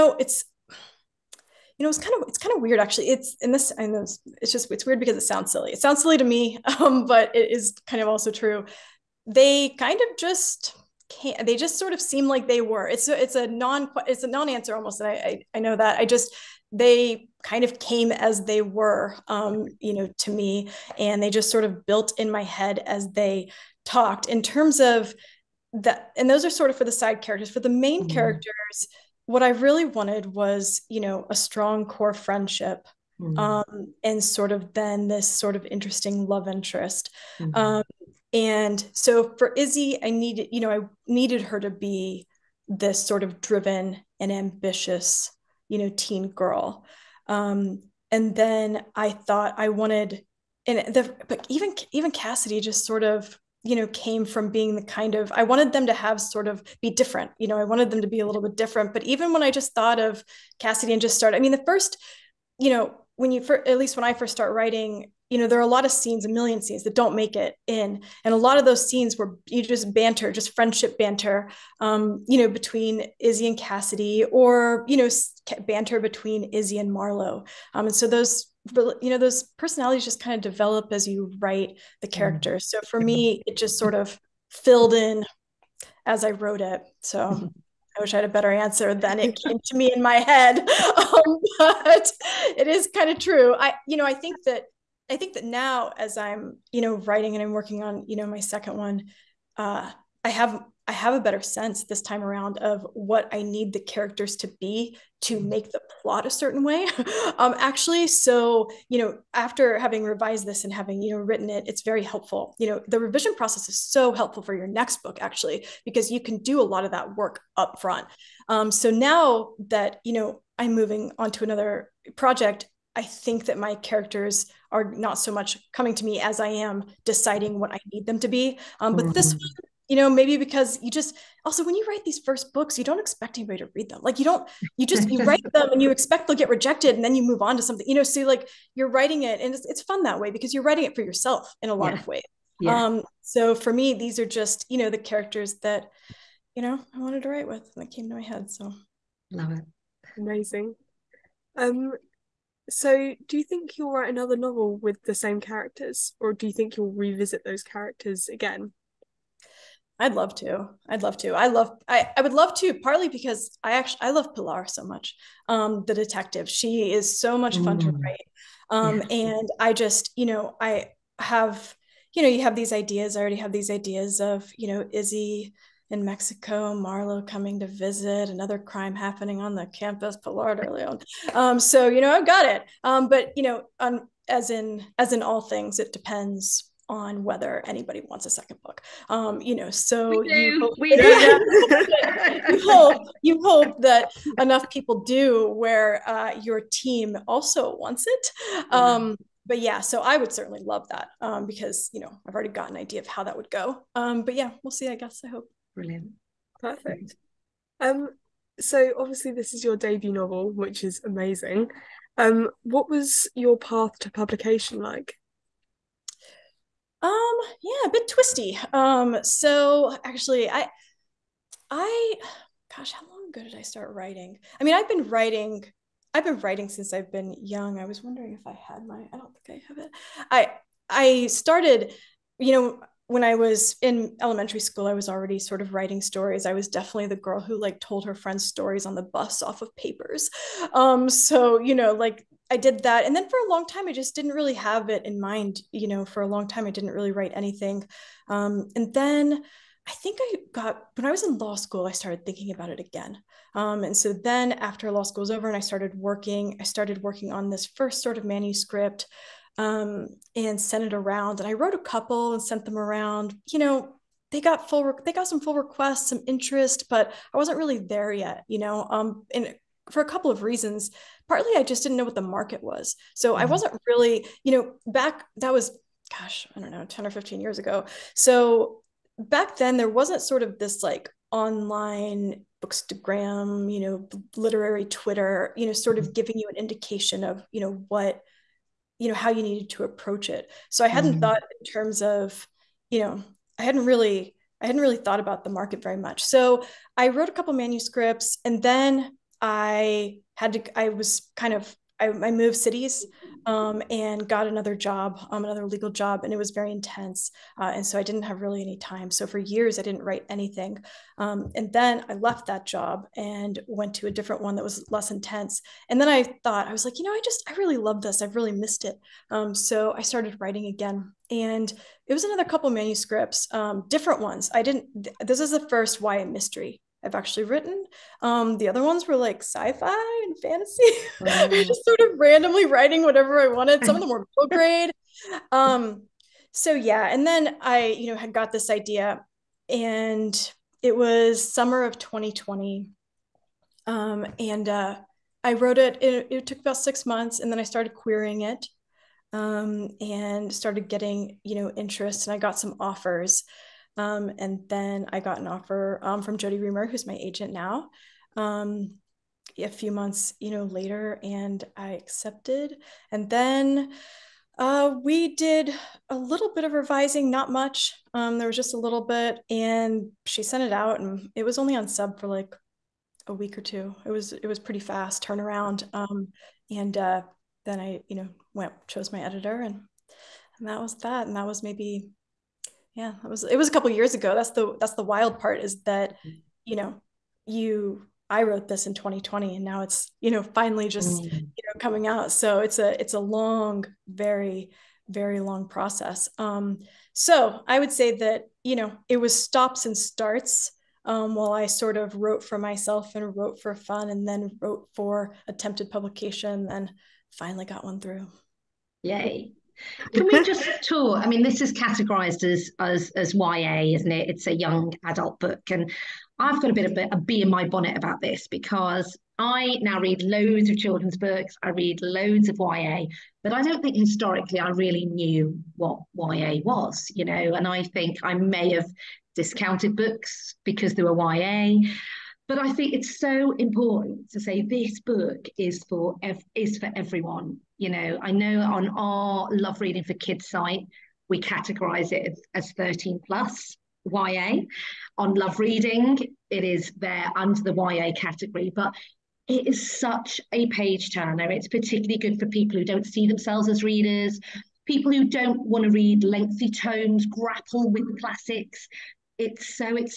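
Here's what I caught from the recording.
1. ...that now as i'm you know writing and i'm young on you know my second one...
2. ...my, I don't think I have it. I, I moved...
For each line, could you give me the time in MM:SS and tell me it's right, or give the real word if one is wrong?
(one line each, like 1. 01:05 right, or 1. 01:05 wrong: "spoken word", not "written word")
1. 01:35 wrong: "working", not "young"
2. 03:48 wrong: "started", not "moved".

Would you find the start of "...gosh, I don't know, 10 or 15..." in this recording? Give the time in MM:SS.
04:36.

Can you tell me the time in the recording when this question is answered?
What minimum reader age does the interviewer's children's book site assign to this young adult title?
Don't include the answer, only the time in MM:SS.
07:22.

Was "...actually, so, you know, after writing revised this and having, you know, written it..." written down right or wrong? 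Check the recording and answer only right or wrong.
wrong.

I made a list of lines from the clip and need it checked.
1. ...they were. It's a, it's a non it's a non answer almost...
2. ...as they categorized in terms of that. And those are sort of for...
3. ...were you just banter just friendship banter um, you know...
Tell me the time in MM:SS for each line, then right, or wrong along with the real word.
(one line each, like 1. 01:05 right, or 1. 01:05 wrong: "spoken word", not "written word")
1. 00:12 right
2. 00:22 wrong: "talked", not "categorized"
3. 01:09 right.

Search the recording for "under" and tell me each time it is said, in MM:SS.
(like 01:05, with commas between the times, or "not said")
07:27.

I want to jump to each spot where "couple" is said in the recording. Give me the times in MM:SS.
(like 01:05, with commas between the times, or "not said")
04:21, 04:30, 04:57, 05:22, 06:23.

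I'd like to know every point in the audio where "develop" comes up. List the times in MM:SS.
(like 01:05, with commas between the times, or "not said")
01:20.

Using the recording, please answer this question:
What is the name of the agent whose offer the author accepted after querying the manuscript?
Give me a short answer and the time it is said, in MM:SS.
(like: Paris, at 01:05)
Jodi Reamer, at 05:56.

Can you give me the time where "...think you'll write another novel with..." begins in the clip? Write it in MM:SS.
02:33.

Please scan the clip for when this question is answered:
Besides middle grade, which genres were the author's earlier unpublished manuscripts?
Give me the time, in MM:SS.
05:29.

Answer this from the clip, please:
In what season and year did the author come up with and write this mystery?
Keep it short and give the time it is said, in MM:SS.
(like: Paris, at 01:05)
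summer of 2020, at 05:41.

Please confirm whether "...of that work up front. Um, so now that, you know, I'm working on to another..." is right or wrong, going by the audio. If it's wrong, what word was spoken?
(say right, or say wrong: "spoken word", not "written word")
wrong: "moving", not "working".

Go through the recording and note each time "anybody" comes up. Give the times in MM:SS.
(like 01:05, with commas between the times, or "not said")
02:13, 03:07.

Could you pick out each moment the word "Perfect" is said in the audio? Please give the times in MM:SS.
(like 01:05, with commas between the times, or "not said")
03:26.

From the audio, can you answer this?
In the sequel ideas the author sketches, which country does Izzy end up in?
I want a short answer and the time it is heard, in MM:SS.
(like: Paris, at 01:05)
Mexico, at 02:56.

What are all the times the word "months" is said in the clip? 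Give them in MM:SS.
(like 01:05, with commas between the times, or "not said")
05:47, 05:59.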